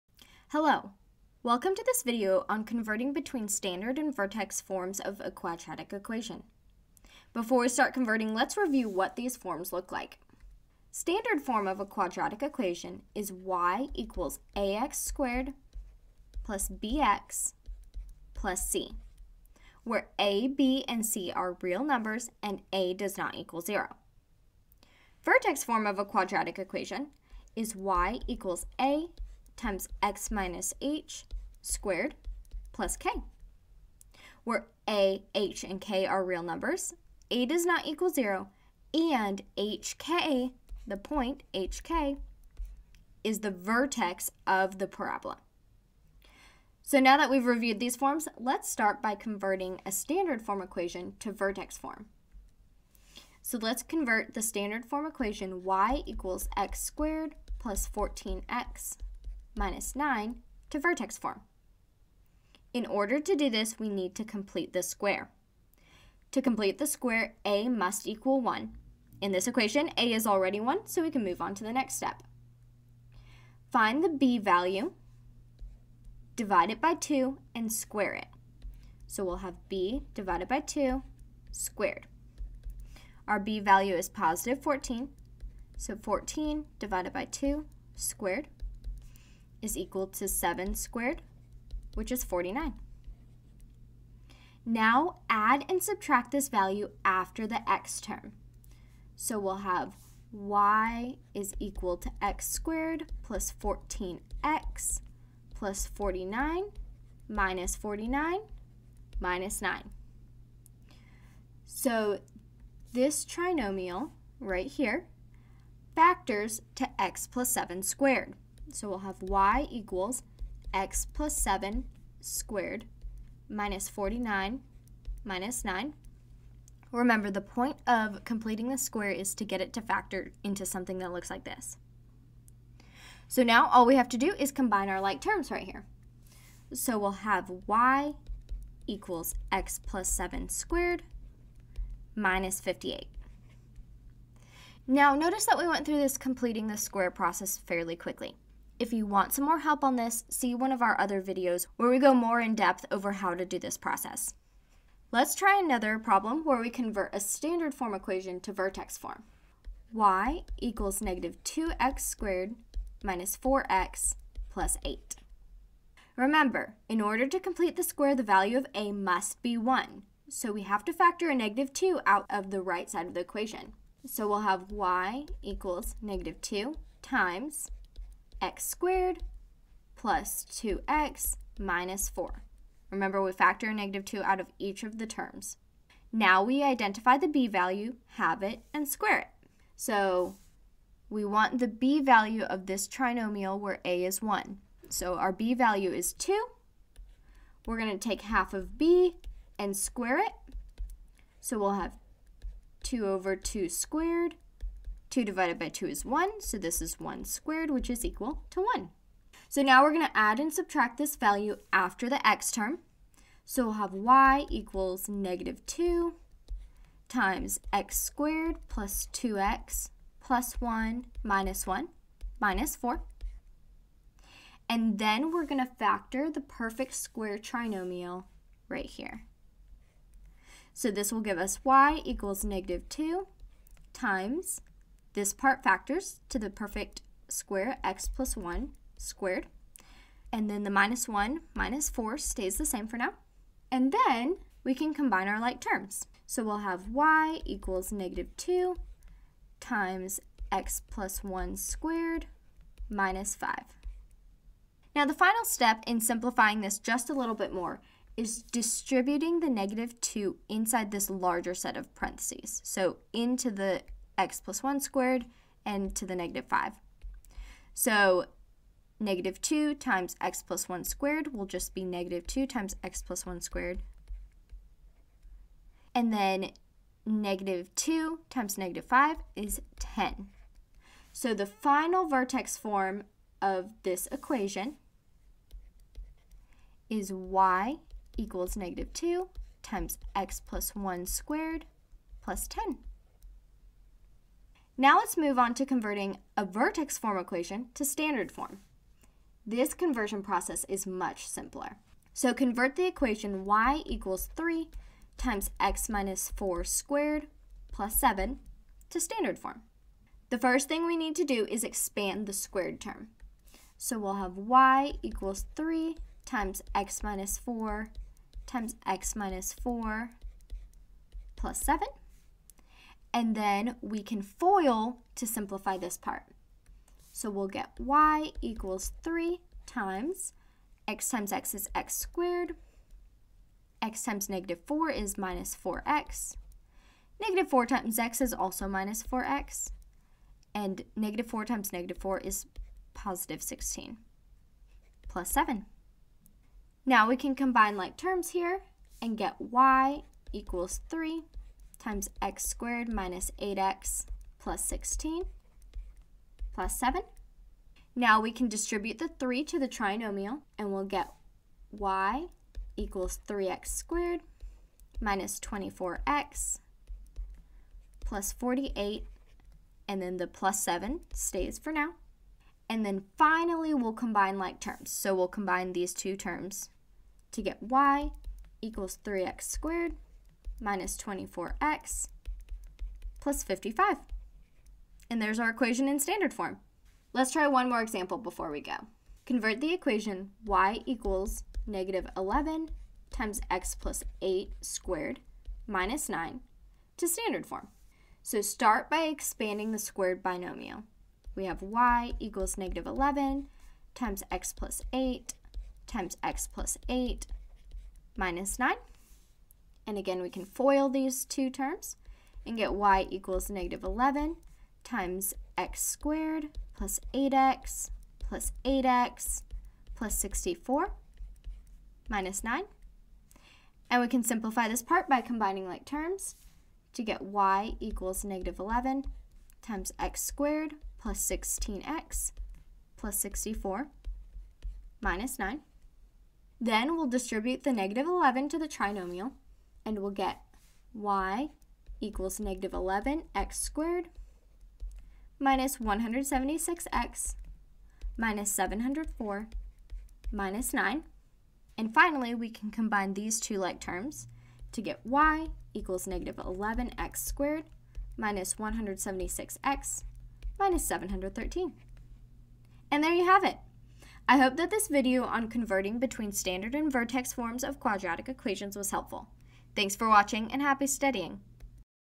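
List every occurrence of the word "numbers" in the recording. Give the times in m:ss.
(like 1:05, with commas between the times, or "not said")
0:21, 0:36.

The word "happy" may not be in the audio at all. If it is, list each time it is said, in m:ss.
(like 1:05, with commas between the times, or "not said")
7:50.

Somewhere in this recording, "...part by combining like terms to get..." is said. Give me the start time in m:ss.
7:04.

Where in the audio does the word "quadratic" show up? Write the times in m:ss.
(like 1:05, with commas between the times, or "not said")
0:05, 0:11, 0:26, 7:47.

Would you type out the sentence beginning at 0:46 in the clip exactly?
So now that we've reviewed these forms, let's start by converting a standard form equation to vertex form.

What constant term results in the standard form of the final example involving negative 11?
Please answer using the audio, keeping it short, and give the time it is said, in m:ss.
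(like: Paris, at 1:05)
-713, at 7:40.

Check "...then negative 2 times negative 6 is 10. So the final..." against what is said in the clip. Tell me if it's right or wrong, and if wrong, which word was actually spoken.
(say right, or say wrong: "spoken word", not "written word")
wrong: "5", not "6".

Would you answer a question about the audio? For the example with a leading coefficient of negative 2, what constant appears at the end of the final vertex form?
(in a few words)
10.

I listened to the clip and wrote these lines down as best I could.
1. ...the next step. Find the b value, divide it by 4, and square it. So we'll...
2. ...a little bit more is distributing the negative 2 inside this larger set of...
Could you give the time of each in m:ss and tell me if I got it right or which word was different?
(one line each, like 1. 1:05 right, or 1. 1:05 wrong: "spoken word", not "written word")
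1. 1:11 wrong: "2", not "4"
2. 4:17 right.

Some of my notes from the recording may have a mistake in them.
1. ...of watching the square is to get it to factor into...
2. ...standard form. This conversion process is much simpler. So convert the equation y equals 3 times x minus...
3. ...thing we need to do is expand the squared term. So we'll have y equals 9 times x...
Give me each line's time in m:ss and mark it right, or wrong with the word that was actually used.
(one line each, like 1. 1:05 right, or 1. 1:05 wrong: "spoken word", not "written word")
1. 2:07 wrong: "completing", not "watching"
2. 4:57 right
3. 5:10 wrong: "3", not "9".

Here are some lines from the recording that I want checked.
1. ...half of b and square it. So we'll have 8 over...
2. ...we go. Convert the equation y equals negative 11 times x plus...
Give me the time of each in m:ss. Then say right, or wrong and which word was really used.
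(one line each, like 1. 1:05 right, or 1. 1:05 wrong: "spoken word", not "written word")
1. 3:18 wrong: "2", not "8"
2. 6:28 right.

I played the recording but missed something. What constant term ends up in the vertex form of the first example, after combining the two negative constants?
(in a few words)
-58.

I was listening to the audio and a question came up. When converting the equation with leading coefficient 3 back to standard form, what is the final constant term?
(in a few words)
55.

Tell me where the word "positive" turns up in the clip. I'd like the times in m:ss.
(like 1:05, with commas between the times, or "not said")
1:24, 5:42.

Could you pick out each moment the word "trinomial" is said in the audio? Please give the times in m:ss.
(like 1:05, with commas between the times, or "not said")
1:53, 3:12, 3:47, 5:59, 7:18.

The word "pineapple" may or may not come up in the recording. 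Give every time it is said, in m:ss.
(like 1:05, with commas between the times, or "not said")
not said.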